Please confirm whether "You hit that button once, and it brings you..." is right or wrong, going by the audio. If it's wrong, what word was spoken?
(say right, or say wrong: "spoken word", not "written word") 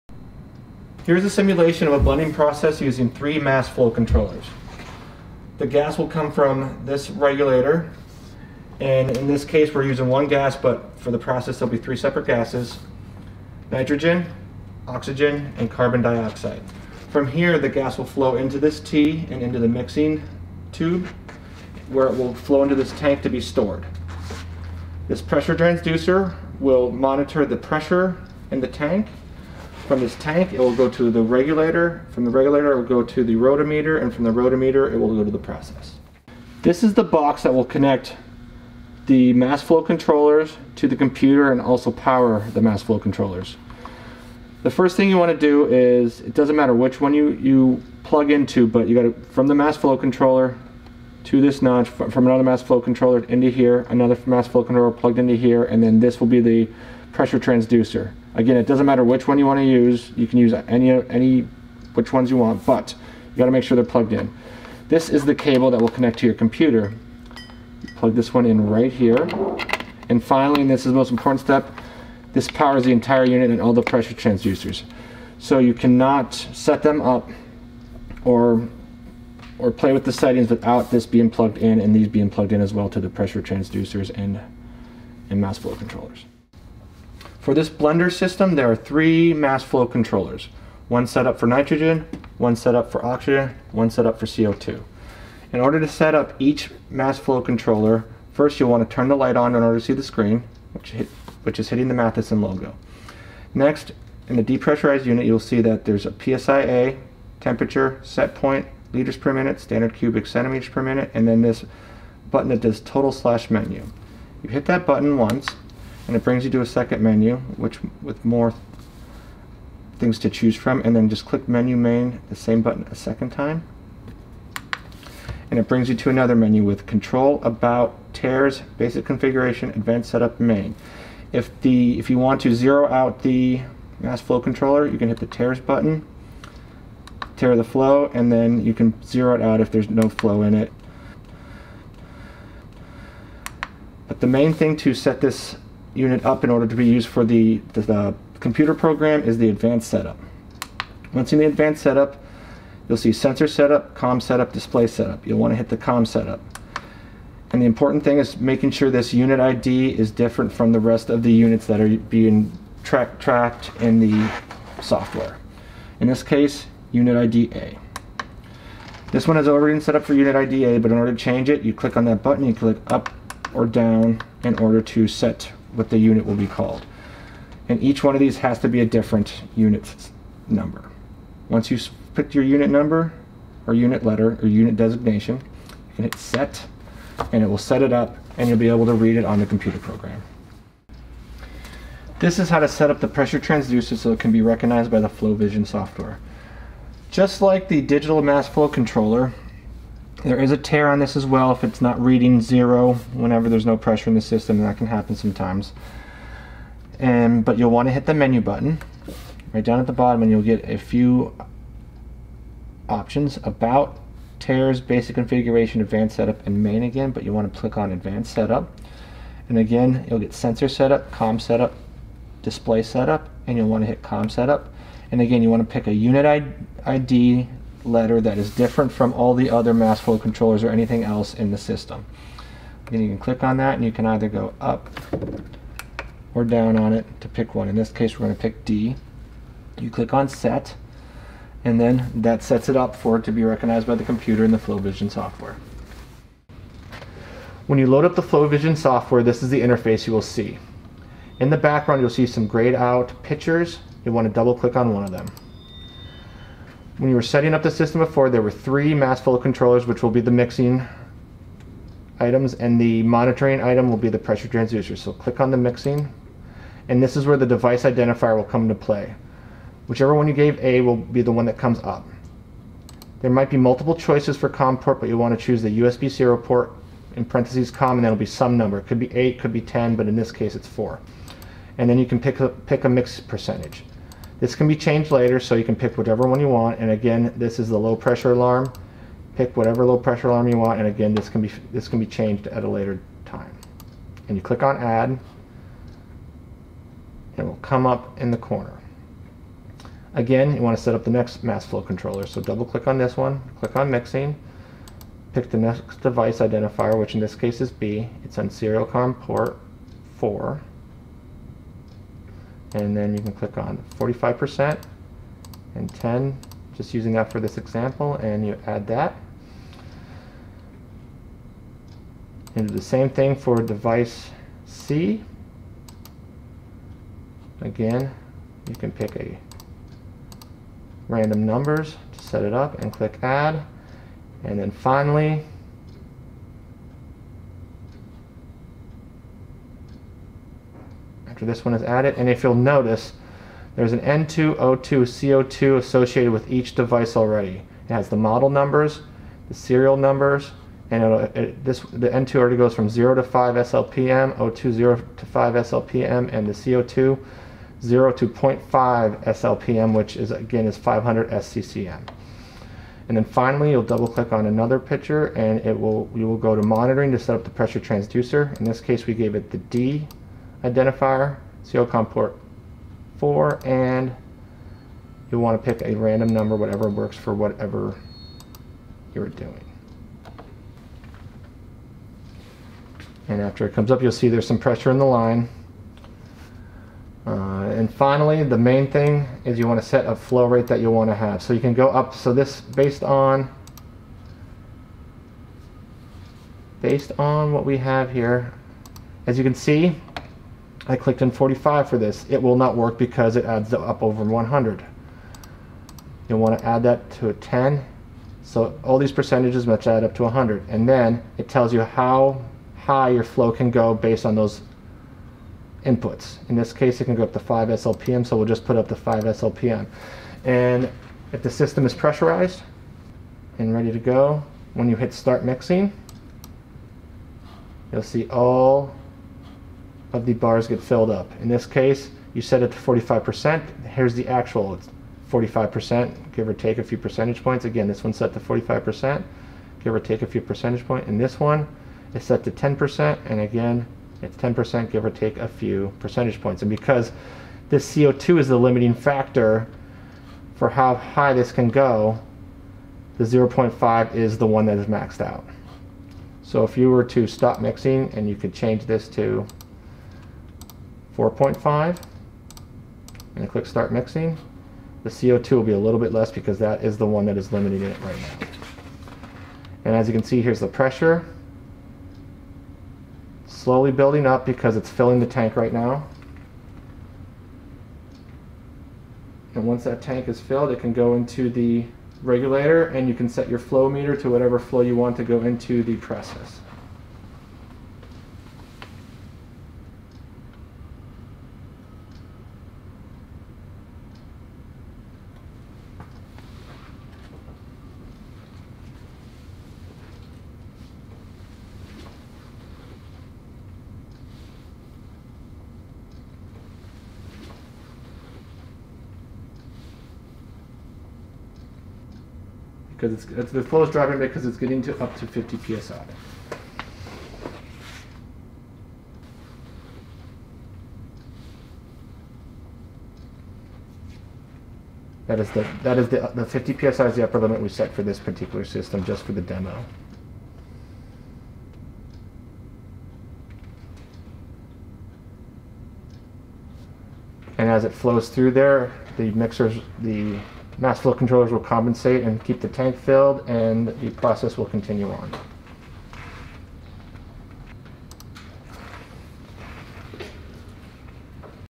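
right.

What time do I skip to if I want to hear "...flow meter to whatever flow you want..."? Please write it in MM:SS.
08:03.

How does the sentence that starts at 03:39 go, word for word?
And again you'll get sensor setup, com setup, display setup and you'll want to hit com setup.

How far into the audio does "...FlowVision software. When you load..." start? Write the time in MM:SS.
04:04.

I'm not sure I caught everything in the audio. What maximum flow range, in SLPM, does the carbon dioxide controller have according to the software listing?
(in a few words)
0.5 SLPM.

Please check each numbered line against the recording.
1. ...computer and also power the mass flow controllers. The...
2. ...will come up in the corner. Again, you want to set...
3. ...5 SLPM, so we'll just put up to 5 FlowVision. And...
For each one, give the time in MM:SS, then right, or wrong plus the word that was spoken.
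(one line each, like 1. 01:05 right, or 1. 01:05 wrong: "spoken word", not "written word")
1. 00:40 right
2. 04:57 right
3. 06:57 wrong: "SLPM", not "FlowVision".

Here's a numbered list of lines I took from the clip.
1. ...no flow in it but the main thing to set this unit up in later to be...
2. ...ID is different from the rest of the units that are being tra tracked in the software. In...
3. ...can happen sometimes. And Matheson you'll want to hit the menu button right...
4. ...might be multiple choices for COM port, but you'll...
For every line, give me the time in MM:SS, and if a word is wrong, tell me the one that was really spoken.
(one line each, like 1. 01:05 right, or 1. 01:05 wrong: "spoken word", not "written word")
1. 02:19 wrong: "order", not "later"
2. 02:39 right
3. 03:24 wrong: "But", not "Matheson"
4. 04:33 right.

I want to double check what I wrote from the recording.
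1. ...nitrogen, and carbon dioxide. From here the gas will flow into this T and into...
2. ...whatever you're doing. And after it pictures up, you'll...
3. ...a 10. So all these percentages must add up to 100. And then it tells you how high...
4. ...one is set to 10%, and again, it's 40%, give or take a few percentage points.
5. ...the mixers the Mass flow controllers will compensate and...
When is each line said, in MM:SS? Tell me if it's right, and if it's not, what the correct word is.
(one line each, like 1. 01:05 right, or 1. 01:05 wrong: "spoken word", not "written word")
1. 00:14 wrong: "oxygen", not "nitrogen"
2. 06:17 wrong: "comes", not "pictures"
3. 06:47 right
4. 07:21 wrong: "10", not "40"
5. 08:59 right.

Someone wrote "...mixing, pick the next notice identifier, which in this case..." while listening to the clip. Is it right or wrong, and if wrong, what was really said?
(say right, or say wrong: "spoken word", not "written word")
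wrong: "device", not "notice".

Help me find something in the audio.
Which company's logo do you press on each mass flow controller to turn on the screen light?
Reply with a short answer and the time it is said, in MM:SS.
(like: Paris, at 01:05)
Matheson, at 01:41.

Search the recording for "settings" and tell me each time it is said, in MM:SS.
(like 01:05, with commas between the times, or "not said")
01:20, 04:17.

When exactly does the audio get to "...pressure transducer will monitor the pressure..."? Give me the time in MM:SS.
00:25.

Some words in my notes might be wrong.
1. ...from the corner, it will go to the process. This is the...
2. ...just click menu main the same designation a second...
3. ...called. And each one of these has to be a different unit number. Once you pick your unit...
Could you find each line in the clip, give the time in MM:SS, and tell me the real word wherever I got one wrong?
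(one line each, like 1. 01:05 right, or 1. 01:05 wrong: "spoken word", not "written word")
1. 00:34 wrong: "rotameter", not "corner"
2. 02:01 wrong: "button", not "designation"
3. 02:56 right.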